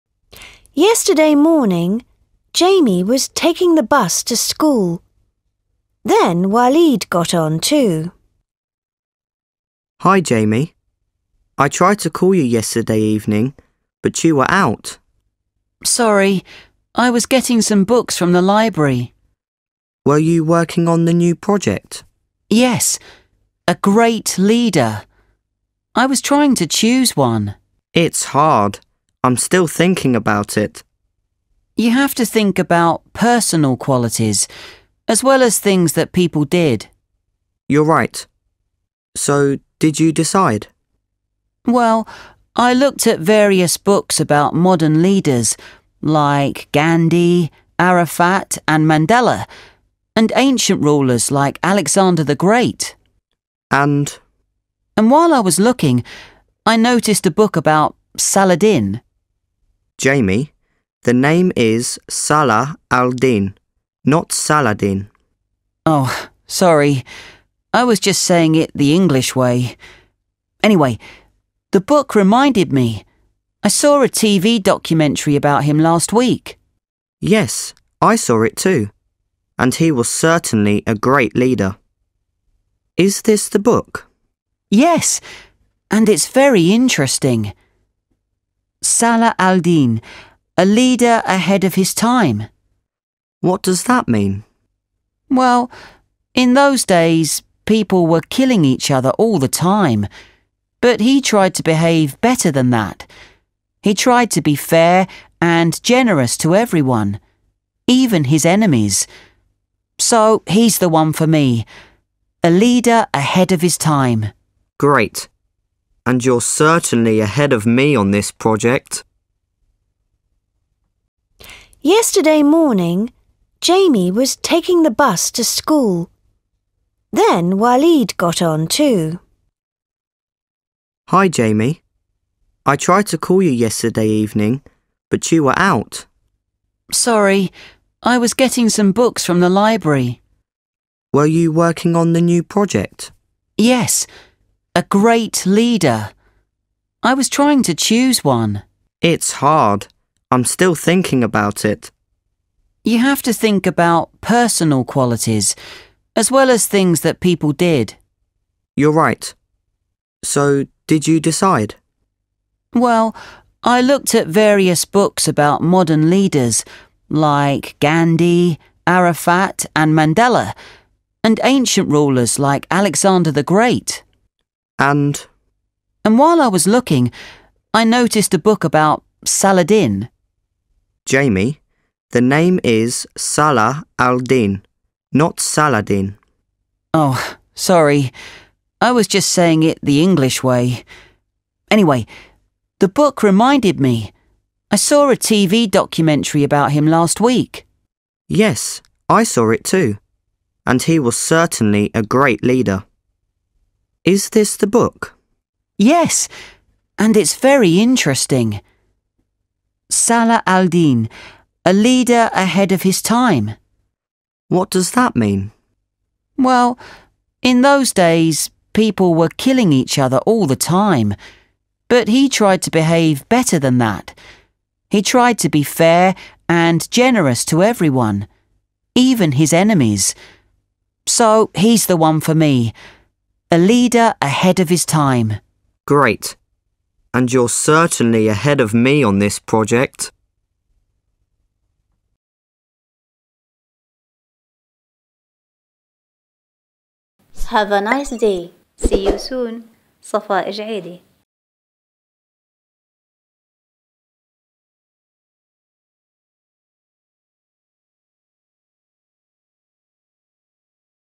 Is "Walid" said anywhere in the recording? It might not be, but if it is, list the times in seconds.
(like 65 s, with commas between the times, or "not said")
6 s, 127 s.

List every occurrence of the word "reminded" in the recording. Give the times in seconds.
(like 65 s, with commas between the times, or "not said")
72 s, 193 s.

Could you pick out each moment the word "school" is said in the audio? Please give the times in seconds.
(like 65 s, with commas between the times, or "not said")
4 s, 125 s.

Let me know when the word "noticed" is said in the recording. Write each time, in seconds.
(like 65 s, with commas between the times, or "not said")
56 s, 177 s.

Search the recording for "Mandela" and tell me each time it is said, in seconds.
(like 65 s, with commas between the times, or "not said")
48 s, 169 s.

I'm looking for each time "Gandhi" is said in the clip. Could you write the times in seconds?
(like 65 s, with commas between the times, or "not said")
46 s, 167 s.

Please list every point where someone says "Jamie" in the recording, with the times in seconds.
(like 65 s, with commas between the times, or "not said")
2 s, 10 s, 60 s, 123 s, 131 s, 181 s.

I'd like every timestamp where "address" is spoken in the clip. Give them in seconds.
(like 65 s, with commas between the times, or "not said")
not said.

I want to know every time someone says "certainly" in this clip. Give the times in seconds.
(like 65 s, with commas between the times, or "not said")
80 s, 116 s, 201 s, 237 s.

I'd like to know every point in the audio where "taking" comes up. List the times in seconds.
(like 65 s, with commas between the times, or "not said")
3 s, 124 s.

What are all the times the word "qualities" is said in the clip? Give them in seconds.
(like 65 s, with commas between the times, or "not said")
33 s, 154 s.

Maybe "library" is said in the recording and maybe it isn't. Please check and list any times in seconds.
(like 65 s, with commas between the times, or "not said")
18 s, 139 s.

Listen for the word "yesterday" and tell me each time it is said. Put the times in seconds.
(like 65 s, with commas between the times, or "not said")
0 s, 12 s, 121 s, 133 s.